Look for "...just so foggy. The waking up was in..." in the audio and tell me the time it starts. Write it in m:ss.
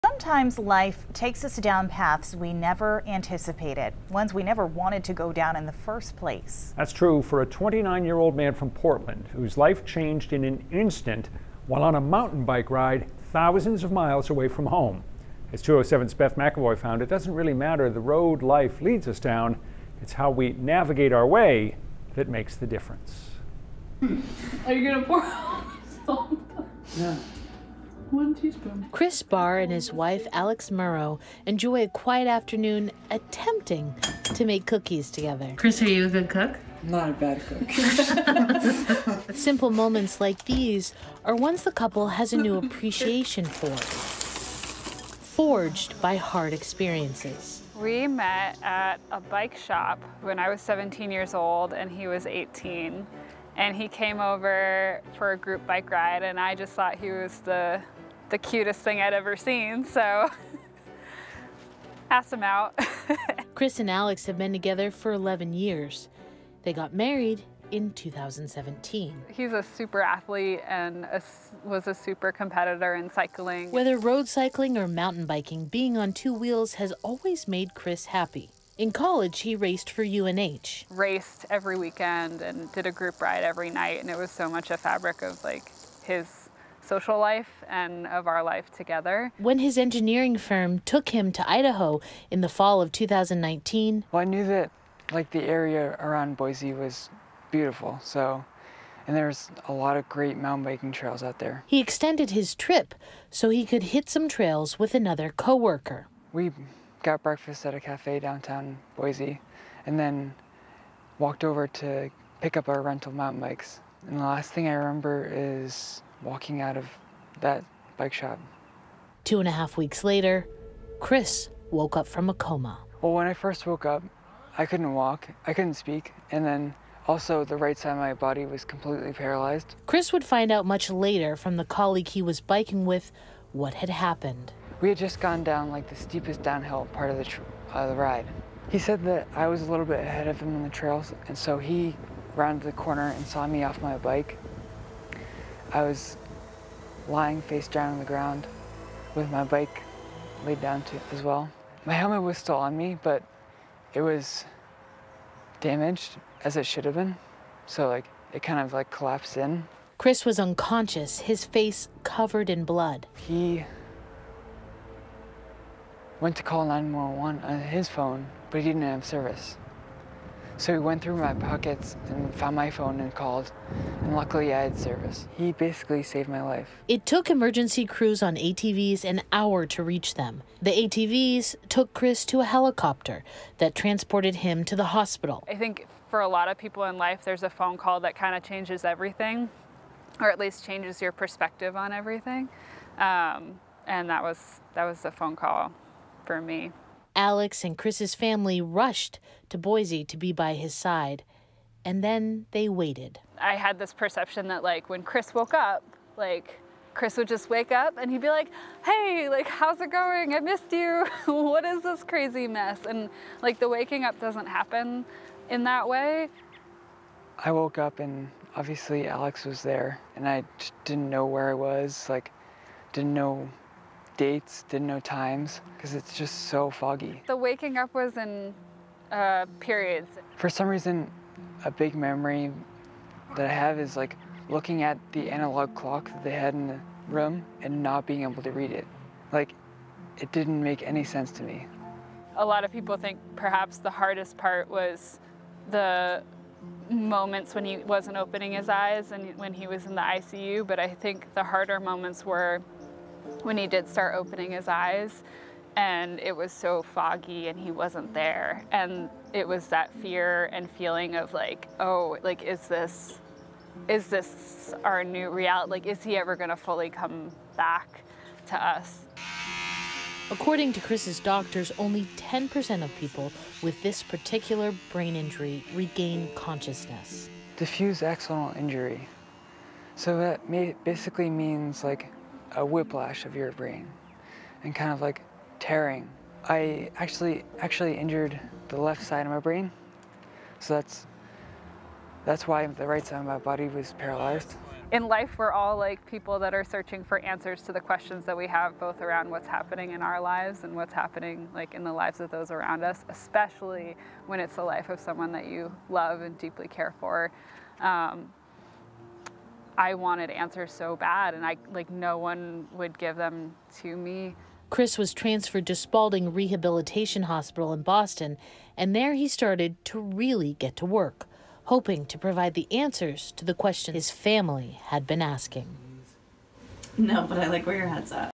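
3:46.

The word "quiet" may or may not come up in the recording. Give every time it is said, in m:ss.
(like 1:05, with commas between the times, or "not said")
0:31.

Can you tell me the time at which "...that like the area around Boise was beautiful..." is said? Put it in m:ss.
1:34.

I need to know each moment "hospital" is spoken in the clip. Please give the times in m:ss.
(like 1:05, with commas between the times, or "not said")
3:04, 5:17.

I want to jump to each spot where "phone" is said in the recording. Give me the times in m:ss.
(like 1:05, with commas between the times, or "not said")
2:47, 2:52, 3:07, 3:15.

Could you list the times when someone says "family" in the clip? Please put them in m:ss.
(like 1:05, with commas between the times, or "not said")
3:18, 5:24.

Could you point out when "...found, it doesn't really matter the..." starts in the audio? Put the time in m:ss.
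0:16.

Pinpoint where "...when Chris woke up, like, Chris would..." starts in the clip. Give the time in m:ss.
3:24.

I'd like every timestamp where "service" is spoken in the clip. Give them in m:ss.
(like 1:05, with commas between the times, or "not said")
2:49, 2:54.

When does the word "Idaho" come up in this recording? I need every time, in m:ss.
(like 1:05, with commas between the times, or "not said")
1:31.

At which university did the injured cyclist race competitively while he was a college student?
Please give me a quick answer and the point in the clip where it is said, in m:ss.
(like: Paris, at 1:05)
UNH, at 1:20.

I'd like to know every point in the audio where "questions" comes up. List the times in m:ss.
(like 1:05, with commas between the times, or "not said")
4:57, 5:23.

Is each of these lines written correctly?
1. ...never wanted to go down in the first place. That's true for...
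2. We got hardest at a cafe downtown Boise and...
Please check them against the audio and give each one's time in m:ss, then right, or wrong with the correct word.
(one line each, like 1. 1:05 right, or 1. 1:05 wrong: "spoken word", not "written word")
1. 0:04 right
2. 1:46 wrong: "breakfast", not "hardest".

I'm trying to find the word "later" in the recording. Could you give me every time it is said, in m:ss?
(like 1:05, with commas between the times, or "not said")
2:00, 2:10.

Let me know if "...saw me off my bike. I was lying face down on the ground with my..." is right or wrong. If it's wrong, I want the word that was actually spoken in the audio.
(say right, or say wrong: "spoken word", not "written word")
right.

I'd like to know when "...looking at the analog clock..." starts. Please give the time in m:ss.
3:54.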